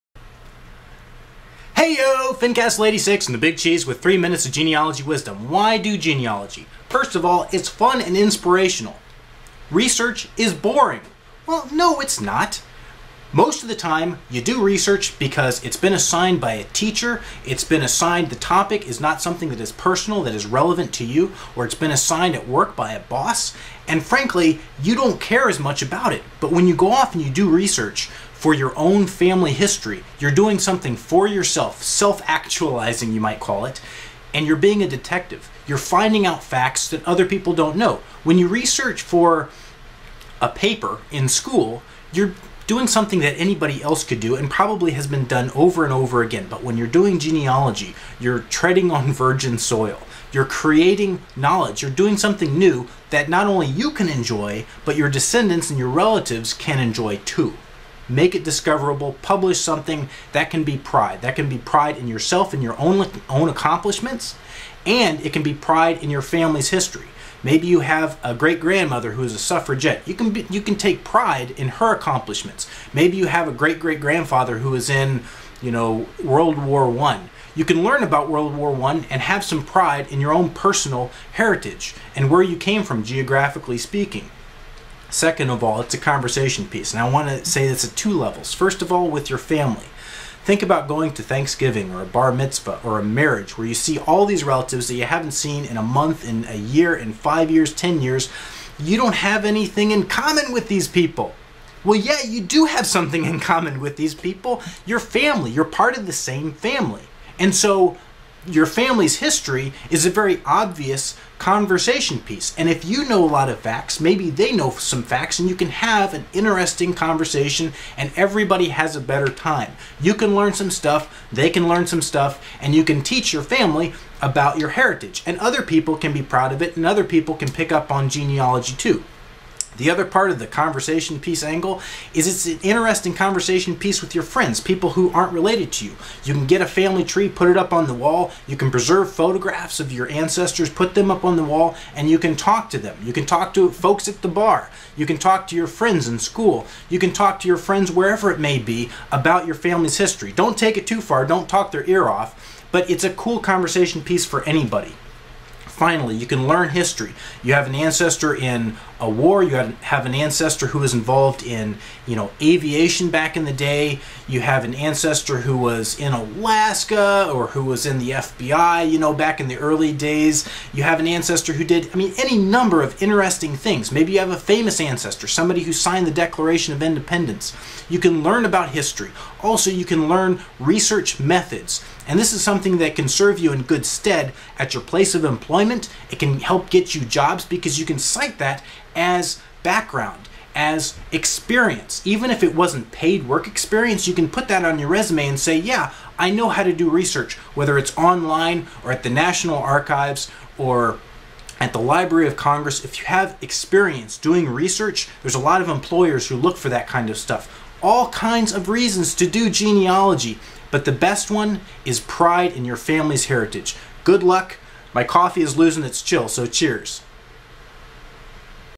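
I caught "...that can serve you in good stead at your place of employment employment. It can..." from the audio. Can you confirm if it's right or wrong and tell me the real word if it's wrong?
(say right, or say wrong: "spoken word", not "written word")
right.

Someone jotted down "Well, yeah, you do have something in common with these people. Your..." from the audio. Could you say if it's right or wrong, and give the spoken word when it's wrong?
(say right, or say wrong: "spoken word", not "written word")
right.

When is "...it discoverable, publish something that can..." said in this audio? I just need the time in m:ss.
0:58.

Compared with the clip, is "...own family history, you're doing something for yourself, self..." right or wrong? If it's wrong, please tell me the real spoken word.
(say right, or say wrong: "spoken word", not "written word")
right.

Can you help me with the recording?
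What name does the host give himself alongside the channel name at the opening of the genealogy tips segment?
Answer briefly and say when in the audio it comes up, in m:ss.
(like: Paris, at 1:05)
The Big Cheese, at 0:03.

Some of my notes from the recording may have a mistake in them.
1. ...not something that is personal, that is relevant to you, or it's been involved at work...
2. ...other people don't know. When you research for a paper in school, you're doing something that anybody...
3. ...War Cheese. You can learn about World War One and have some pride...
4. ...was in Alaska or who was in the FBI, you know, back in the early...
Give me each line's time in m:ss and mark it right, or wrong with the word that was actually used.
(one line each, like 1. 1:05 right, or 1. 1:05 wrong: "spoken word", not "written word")
1. 0:18 wrong: "assigned", not "involved"
2. 0:37 right
3. 1:16 wrong: "One", not "Cheese"
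4. 2:45 right.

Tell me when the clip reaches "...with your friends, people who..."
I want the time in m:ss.
2:14.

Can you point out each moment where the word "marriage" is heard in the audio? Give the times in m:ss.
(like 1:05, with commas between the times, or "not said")
1:33.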